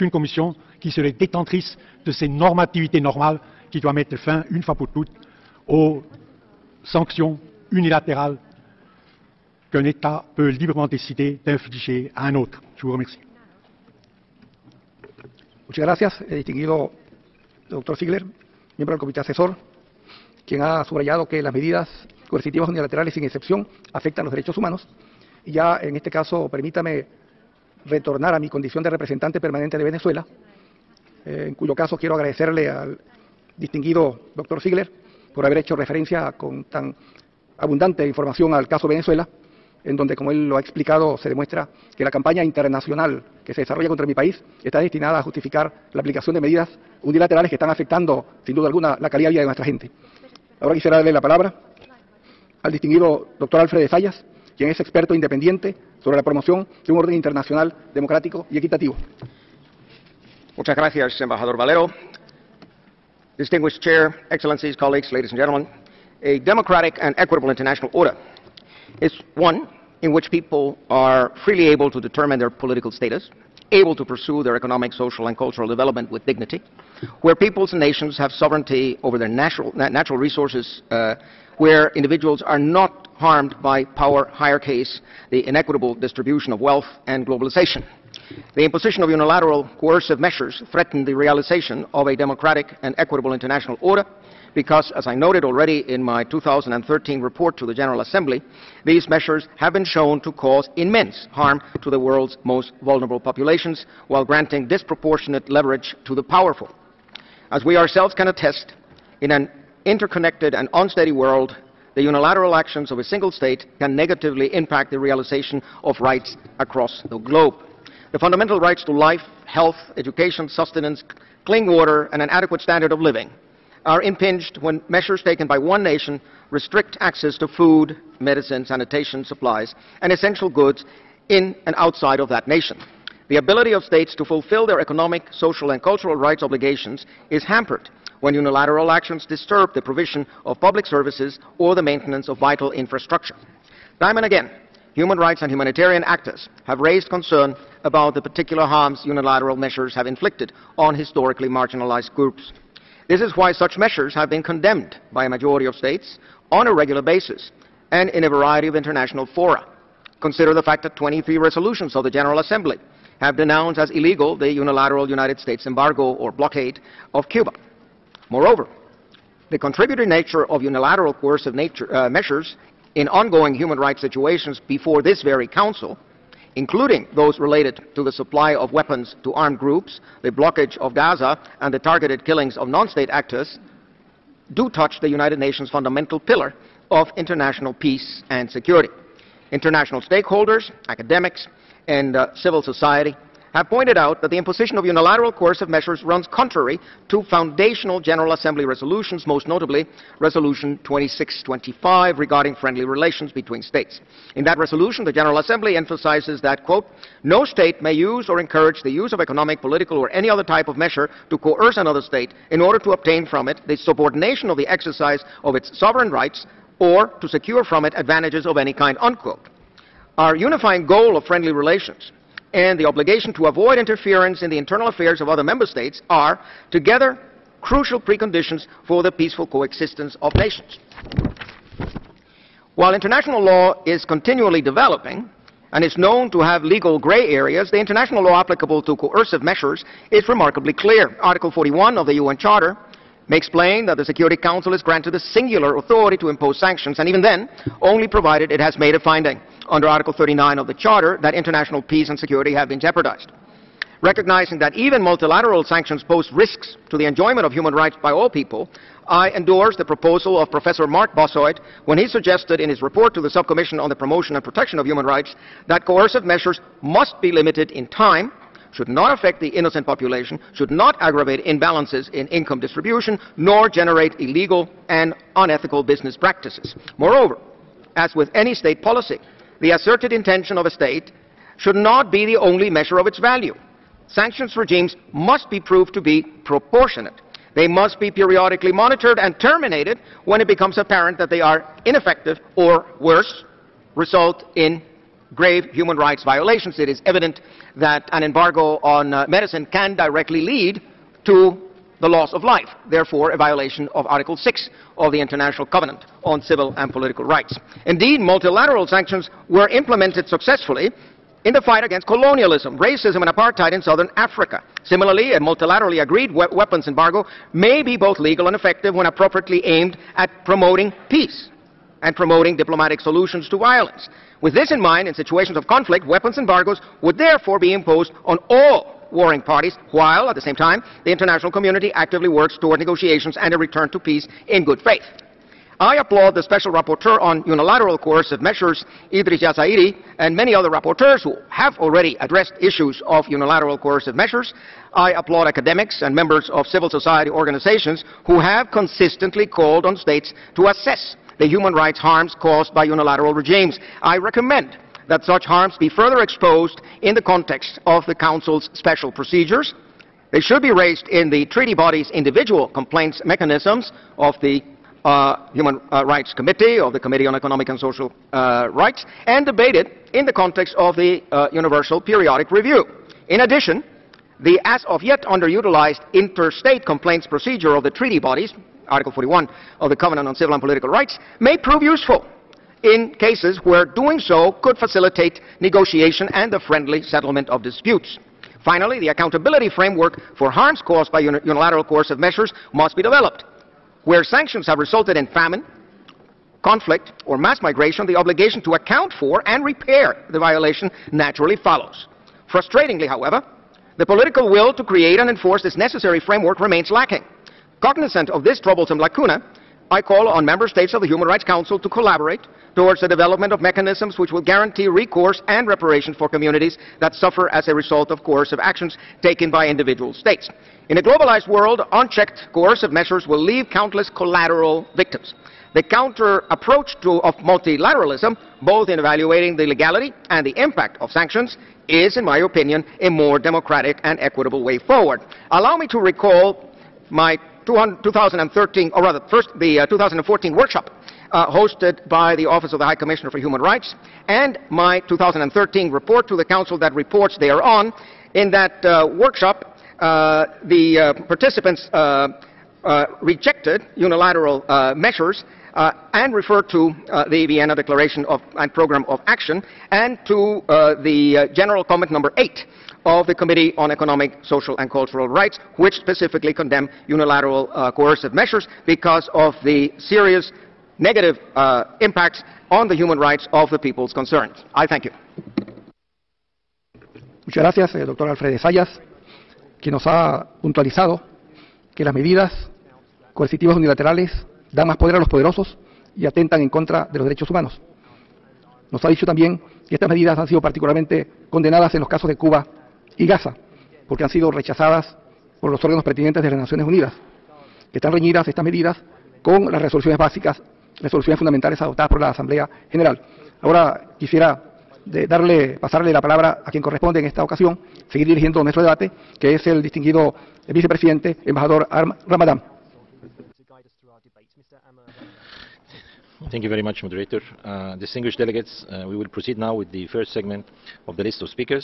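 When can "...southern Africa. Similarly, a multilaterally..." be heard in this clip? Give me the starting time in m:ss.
5:13.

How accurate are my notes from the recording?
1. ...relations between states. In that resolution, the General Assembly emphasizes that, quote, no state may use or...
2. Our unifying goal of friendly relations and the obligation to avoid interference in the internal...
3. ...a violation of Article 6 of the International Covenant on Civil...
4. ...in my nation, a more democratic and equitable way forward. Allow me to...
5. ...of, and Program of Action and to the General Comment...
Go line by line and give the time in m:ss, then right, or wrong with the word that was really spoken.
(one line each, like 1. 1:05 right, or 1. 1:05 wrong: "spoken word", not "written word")
1. 3:22 right
2. 3:40 right
3. 5:03 right
4. 7:12 wrong: "opinion", not "nation"
5. 7:38 right.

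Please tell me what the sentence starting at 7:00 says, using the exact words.
In a globalized world, unchecked coercive measures will leave countless collateral victims.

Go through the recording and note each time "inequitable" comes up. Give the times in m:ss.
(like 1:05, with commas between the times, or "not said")
1:25.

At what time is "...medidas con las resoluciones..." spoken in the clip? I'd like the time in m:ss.
8:18.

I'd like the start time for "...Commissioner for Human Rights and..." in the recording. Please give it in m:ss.
7:22.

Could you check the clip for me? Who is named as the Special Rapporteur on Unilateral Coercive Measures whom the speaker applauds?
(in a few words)
Idriss Jazairy.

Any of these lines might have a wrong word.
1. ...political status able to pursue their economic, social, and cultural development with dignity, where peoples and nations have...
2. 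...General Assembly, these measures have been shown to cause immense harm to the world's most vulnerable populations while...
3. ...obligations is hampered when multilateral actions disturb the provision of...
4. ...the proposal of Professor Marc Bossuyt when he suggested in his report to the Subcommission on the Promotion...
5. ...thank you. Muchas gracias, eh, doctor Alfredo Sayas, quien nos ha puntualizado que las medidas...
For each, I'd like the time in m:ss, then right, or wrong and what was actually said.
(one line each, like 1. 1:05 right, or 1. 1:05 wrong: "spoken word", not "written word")
1. 1:12 right
2. 1:37 right
3. 2:16 wrong: "unilateral", not "multilateral"
4. 4:19 right
5. 7:54 right.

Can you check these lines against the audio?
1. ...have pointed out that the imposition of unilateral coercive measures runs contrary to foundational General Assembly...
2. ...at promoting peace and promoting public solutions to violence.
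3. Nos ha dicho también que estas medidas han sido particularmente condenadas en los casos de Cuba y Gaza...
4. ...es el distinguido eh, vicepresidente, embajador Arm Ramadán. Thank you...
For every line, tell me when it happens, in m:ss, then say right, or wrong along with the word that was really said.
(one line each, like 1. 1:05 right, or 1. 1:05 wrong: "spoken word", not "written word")
1. 3:13 right
2. 5:20 wrong: "diplomatic", not "public"
3. 8:08 right
4. 8:29 right.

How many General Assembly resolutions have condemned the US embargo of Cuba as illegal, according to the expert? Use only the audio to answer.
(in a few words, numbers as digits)
23.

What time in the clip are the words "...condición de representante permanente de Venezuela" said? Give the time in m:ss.
0:28.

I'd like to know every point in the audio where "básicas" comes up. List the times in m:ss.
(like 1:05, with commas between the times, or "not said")
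8:20.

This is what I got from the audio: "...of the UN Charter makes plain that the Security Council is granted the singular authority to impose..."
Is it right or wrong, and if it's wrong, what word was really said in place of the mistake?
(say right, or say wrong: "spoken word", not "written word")
right.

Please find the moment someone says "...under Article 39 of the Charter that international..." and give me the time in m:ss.
4:09.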